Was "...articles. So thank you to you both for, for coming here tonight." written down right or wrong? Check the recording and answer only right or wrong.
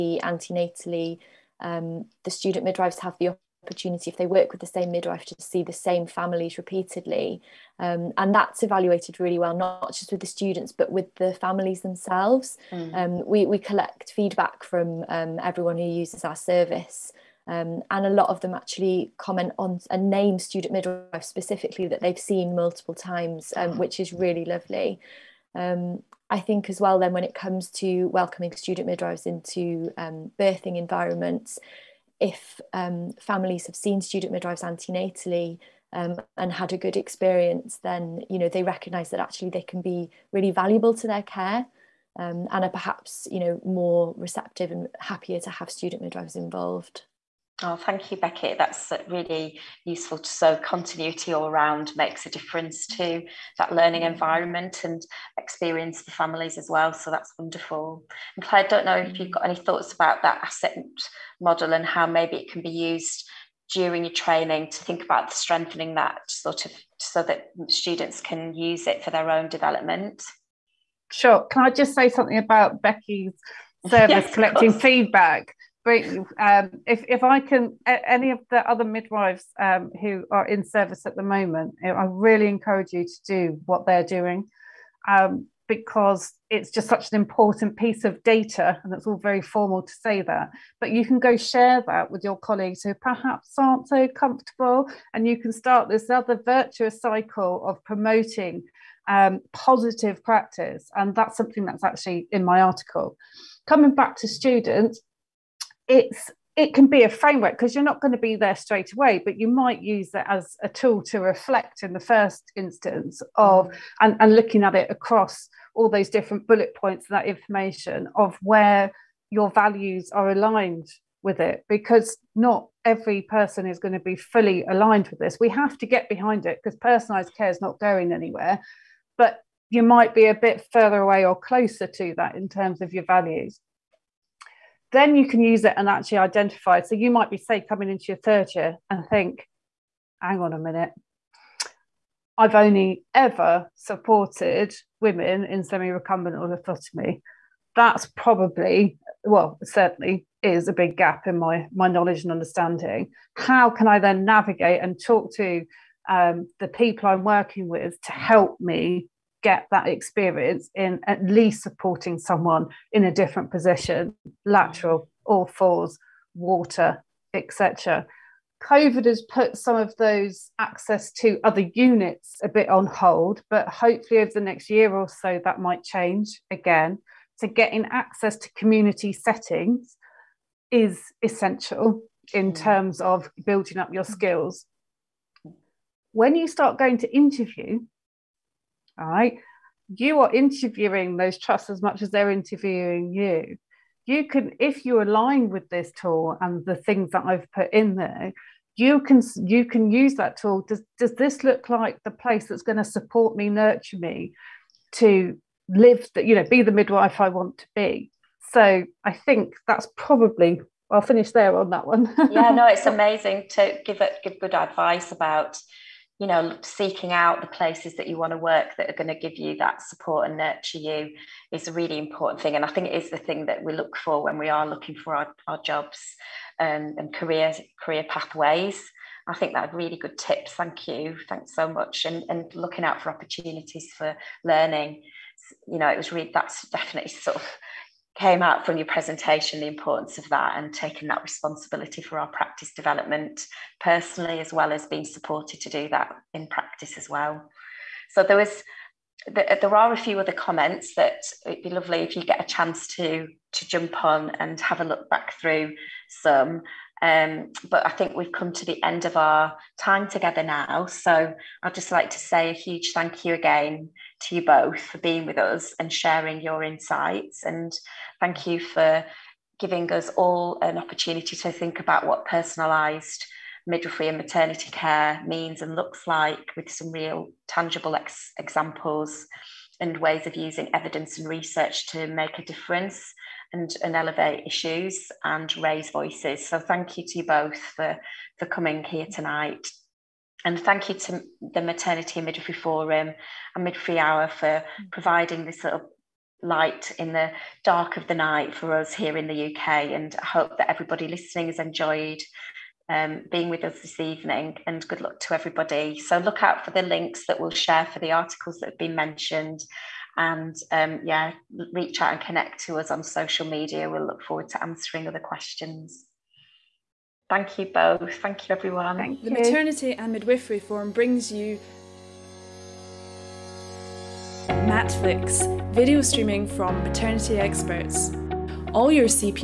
wrong.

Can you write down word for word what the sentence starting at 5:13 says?
We'll look forward to answering other questions.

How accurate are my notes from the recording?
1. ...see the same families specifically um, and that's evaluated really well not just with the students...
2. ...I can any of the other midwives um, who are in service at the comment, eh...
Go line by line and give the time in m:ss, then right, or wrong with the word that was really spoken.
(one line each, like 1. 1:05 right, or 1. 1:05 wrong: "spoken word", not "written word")
1. 0:05 wrong: "repeatedly", not "specifically"
2. 1:17 wrong: "moment", not "comment".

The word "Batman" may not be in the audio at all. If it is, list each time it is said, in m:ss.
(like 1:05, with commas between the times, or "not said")
not said.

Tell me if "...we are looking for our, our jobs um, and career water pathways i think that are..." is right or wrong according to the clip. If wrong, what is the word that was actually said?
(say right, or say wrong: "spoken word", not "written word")
wrong: "career", not "water".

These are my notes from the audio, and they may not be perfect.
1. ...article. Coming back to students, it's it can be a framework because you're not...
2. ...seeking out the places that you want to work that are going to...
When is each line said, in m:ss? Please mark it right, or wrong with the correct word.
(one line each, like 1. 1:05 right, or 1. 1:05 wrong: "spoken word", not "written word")
1. 1:42 right
2. 3:36 right.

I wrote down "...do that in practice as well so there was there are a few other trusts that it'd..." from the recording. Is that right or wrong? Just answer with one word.
wrong.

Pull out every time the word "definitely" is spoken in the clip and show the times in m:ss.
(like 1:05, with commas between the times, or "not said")
3:56.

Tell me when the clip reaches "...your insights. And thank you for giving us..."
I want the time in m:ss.
4:26.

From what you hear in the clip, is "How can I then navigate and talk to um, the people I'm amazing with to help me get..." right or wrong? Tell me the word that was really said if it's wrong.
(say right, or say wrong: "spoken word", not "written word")
wrong: "working", not "amazing".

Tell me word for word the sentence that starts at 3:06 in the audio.
When you start going to interview, all right.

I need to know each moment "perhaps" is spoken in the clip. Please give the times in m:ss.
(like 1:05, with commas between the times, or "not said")
0:42, 1:32.